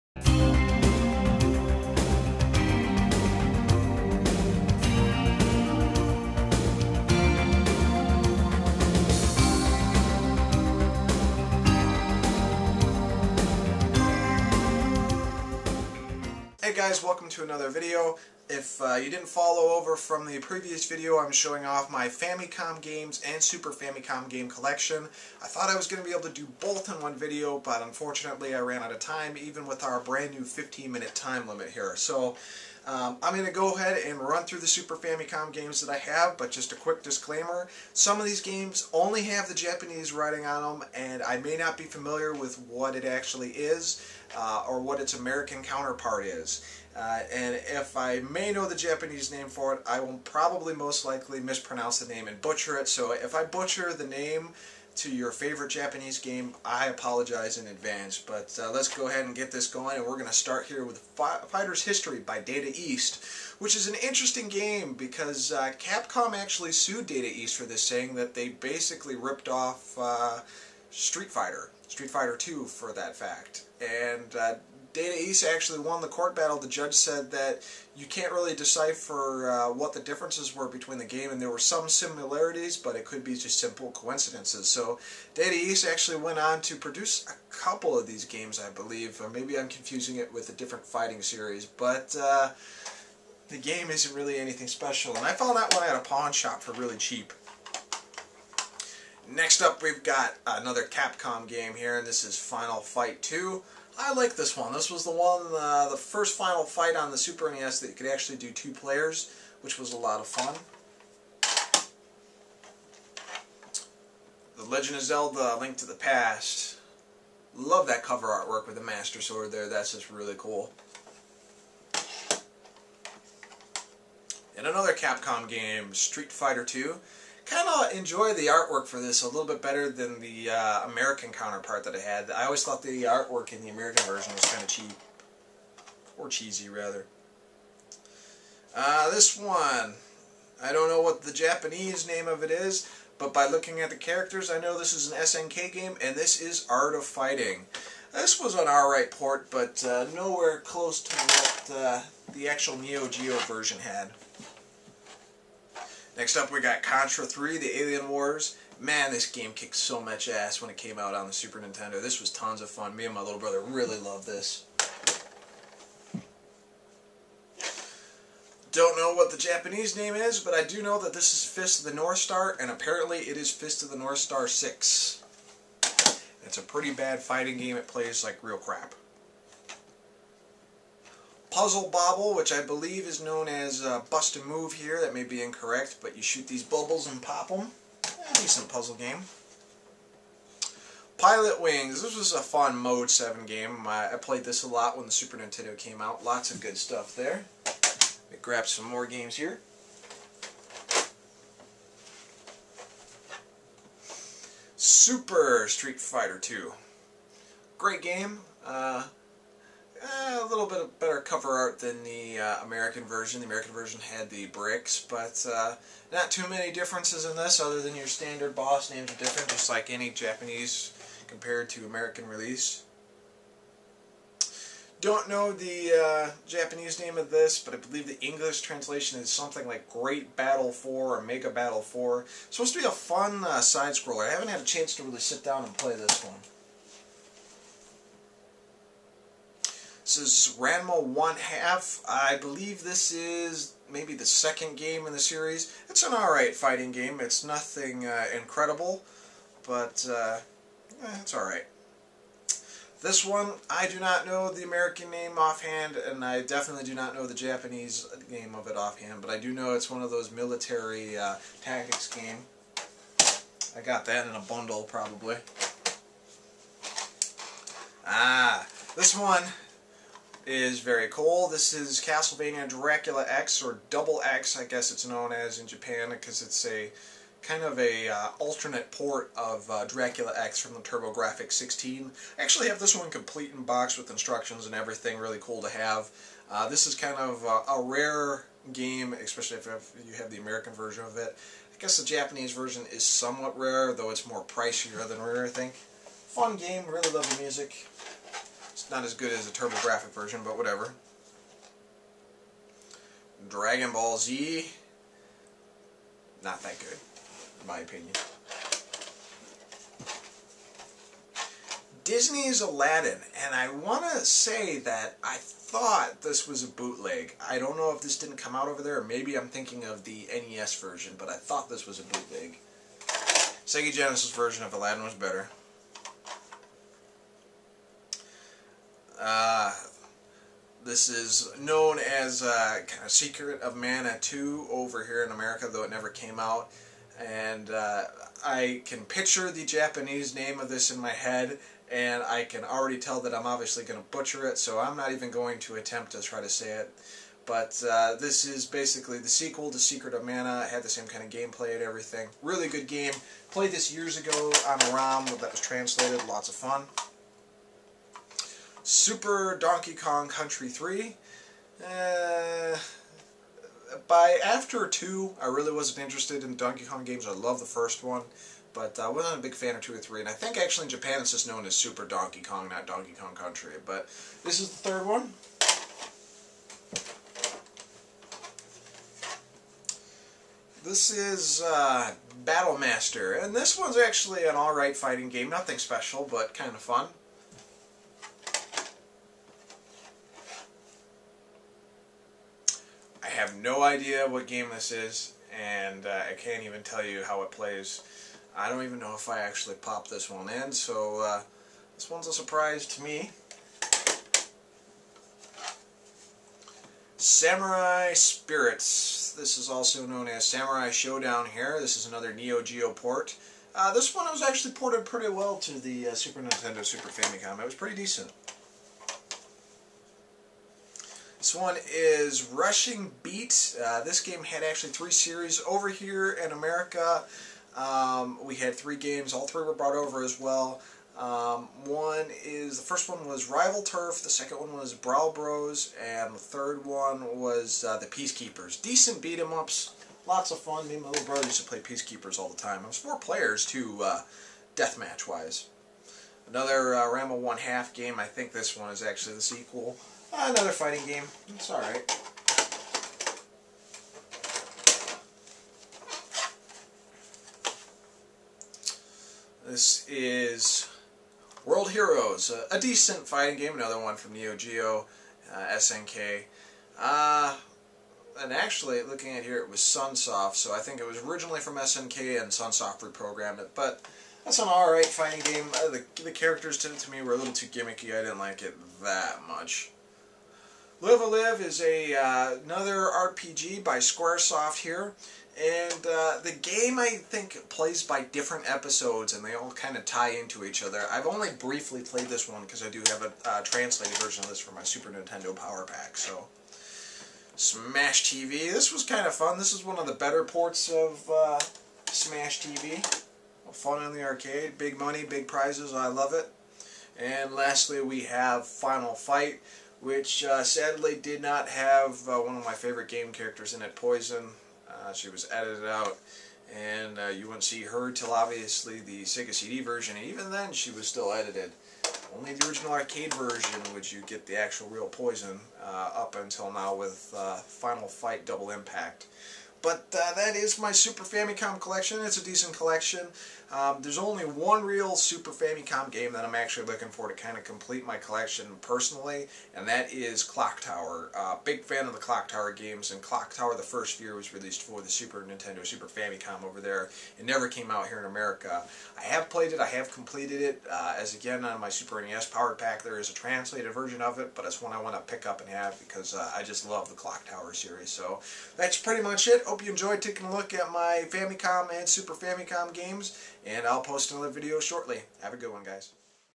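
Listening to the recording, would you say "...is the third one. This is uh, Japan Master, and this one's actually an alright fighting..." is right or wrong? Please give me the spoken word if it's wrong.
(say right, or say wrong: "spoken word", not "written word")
wrong: "Battle", not "Japan".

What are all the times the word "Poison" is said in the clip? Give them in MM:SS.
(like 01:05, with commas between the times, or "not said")
08:33, 08:45.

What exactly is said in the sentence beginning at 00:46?
Uh, and if I may know the Japanese name for it, I will probably most likely mispronounce the name and butcher it.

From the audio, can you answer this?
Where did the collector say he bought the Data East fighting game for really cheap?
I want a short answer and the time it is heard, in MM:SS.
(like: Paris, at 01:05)
A pawn shop, at 01:35.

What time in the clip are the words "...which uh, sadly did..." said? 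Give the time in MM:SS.
08:30.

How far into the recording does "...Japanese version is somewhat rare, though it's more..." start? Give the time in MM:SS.
04:52.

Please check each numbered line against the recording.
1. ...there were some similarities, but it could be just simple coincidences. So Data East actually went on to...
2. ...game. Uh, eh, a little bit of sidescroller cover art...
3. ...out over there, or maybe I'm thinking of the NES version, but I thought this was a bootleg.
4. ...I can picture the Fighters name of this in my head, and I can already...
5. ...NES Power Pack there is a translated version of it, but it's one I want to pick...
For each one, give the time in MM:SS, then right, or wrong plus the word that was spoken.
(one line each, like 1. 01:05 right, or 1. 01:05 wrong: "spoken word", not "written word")
1. 01:21 right
2. 03:28 wrong: "better", not "sidescroller"
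3. 05:18 right
4. 05:38 wrong: "Japanese", not "Fighters"
5. 09:12 right.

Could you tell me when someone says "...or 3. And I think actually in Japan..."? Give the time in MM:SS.
06:09.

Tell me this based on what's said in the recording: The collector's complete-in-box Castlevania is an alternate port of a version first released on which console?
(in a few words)
TurboGrafx 16.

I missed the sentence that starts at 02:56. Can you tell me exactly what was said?
It's a pretty bad fighting game.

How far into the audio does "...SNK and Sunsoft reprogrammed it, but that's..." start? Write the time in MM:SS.
07:51.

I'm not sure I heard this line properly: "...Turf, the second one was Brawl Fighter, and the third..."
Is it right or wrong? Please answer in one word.
wrong.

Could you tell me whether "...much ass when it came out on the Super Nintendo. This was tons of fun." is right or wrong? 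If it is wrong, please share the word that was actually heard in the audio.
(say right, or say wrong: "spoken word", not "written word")
right.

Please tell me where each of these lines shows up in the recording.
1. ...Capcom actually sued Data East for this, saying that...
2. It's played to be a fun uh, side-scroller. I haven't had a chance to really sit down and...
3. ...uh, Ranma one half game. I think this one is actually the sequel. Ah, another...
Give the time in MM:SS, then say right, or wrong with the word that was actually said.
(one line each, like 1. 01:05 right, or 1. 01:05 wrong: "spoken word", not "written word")
1. 01:05 right
2. 03:52 wrong: "supposed", not "played"
3. 07:26 right.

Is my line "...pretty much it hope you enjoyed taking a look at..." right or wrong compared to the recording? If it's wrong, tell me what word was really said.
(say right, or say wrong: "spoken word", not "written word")
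right.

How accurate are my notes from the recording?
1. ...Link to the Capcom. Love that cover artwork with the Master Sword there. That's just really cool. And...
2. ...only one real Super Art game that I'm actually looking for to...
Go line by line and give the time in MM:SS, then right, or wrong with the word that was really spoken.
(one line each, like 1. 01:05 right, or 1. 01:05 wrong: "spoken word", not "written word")
1. 01:55 wrong: "Past", not "Capcom"
2. 08:54 wrong: "Famicom", not "Art".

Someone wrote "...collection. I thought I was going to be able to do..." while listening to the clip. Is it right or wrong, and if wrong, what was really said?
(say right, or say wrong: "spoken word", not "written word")
right.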